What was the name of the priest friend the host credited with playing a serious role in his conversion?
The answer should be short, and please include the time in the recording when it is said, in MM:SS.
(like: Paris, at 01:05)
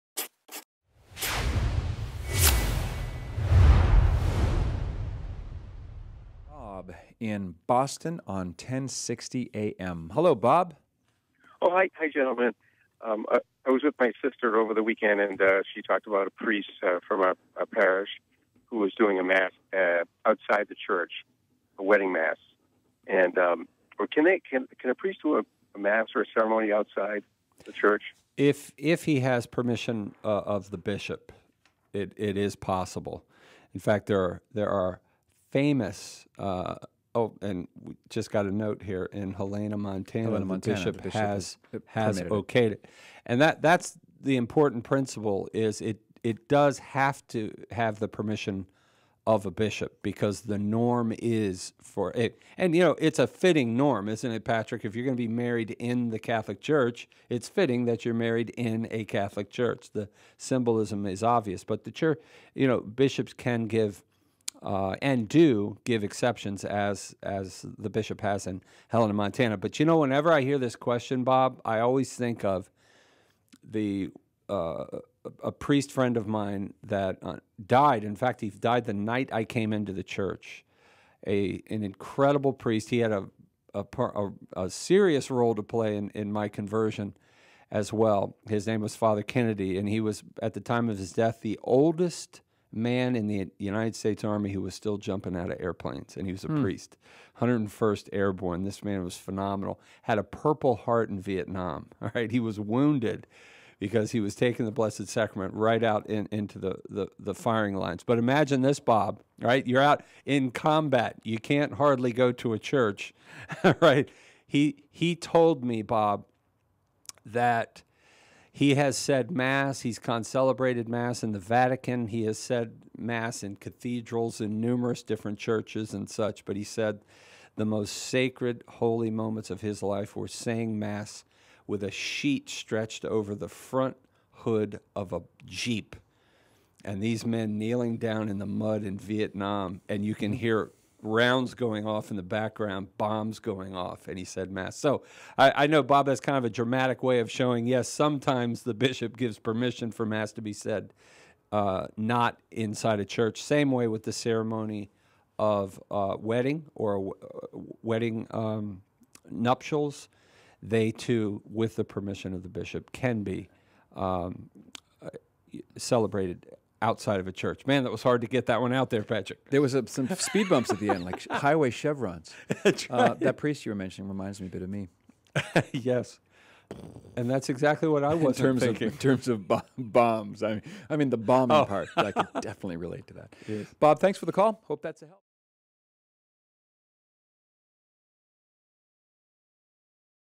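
Father Kennedy, at 01:28.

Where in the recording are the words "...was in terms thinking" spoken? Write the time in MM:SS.
02:58.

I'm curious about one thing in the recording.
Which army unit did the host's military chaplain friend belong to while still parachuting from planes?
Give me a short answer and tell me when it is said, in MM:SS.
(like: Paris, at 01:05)
101st Airborne, at 01:37.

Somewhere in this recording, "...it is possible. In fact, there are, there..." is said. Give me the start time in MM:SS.
00:32.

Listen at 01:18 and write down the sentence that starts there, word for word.
In fact, he died the night I came into the church.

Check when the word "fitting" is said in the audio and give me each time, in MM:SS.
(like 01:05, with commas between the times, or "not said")
00:53, 00:57.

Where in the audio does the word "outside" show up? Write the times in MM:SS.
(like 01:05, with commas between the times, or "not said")
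00:20, 00:26, 02:46.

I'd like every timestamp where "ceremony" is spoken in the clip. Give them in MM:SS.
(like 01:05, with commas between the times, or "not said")
00:26, 02:34.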